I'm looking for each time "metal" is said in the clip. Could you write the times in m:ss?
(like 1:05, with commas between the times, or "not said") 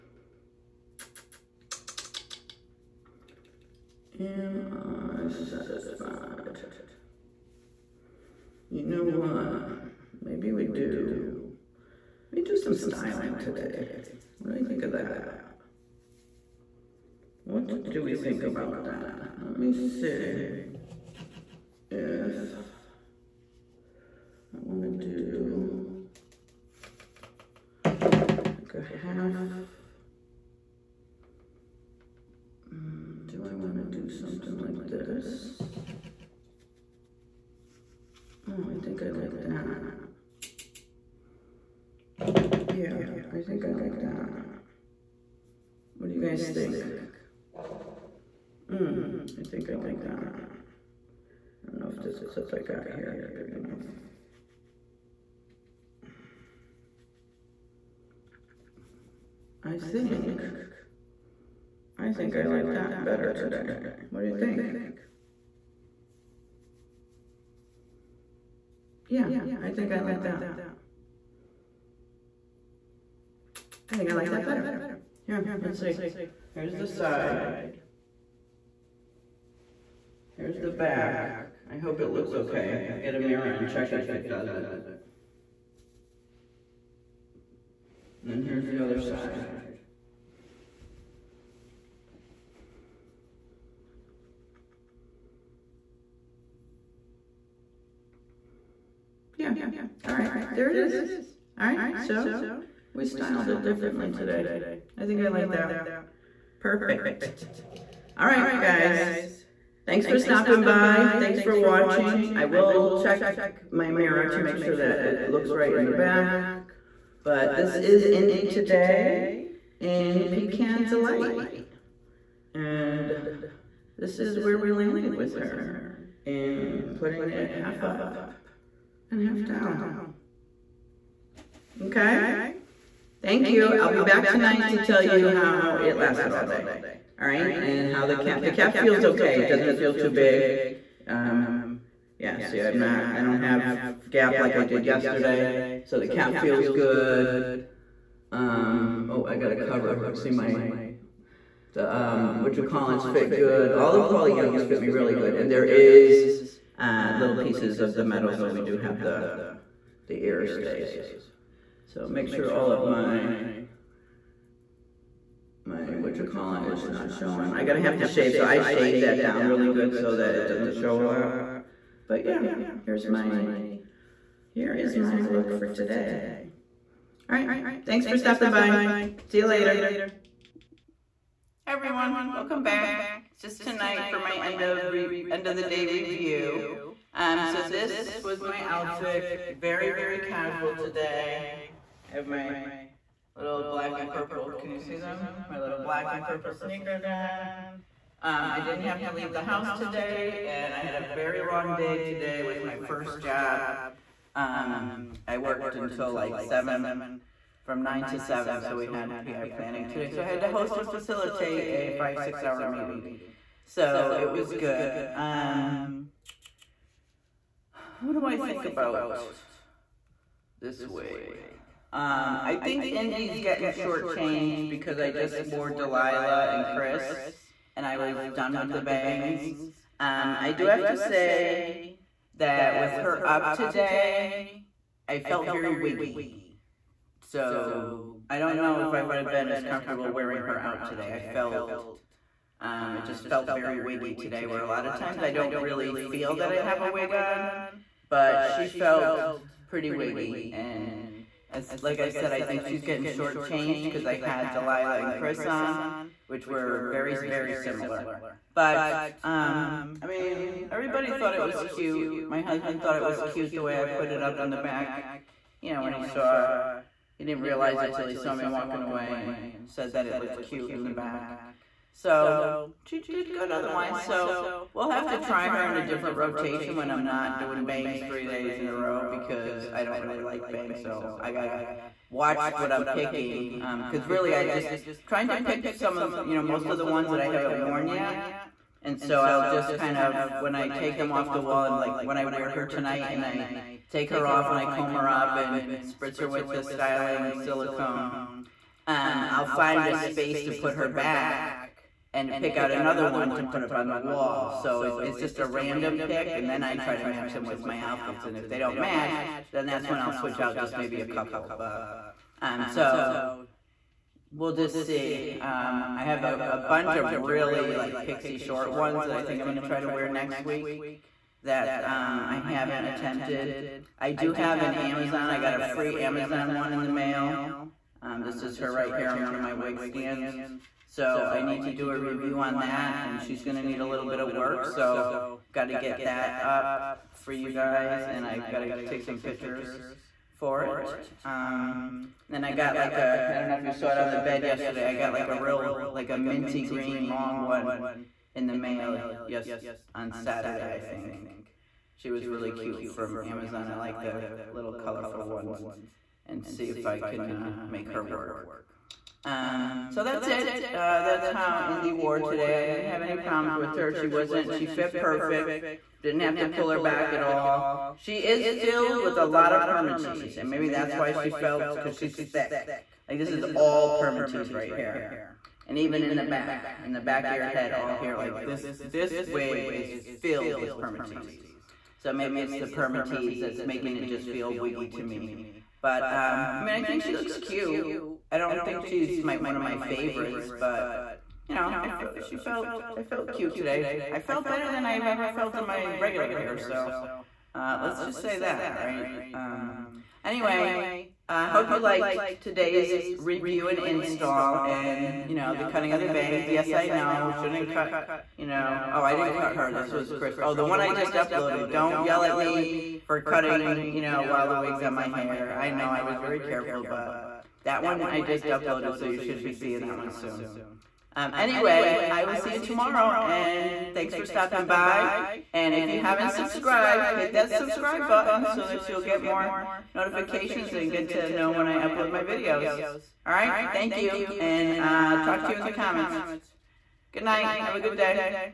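2:38.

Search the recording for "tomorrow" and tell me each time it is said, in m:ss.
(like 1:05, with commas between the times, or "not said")
7:02.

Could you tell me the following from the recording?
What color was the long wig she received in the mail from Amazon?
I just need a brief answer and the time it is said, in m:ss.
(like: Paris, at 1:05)
minty green, at 5:46.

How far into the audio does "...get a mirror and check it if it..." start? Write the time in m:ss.
1:22.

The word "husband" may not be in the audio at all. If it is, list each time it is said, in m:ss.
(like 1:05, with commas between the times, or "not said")
4:22.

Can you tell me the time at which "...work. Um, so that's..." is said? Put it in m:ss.
5:58.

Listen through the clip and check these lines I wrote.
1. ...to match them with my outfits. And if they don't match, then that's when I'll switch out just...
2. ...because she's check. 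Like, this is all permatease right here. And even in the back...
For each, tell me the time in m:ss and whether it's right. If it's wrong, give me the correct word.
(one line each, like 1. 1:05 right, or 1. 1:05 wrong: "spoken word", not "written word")
1. 5:06 right
2. 6:11 wrong: "thick", not "check".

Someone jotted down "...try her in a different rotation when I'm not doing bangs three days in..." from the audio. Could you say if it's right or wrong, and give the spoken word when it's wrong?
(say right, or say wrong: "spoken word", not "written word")
right.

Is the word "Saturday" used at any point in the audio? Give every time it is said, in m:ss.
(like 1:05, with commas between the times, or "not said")
5:50.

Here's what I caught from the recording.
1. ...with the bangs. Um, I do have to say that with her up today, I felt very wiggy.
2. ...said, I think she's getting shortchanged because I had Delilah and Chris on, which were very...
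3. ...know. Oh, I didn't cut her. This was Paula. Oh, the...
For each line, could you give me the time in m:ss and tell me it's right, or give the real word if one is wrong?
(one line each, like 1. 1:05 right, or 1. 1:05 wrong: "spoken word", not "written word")
1. 3:48 right
2. 4:12 right
3. 6:48 wrong: "Chris", not "Paula".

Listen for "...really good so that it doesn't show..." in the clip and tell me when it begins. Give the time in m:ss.
2:49.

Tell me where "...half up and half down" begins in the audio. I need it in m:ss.
2:07.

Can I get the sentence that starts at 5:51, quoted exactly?
She was really cute from Amazon.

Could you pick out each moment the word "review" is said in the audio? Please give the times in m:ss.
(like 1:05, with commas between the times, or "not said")
3:05, 5:31, 6:43.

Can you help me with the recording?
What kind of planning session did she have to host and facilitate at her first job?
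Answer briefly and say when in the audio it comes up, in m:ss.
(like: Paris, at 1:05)
PI planning, at 3:29.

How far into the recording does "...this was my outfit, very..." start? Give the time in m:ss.
3:07.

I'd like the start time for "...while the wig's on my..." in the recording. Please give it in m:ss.
6:54.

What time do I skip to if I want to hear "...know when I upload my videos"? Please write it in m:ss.
7:11.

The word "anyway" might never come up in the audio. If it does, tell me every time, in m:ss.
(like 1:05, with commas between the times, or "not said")
6:40, 7:01.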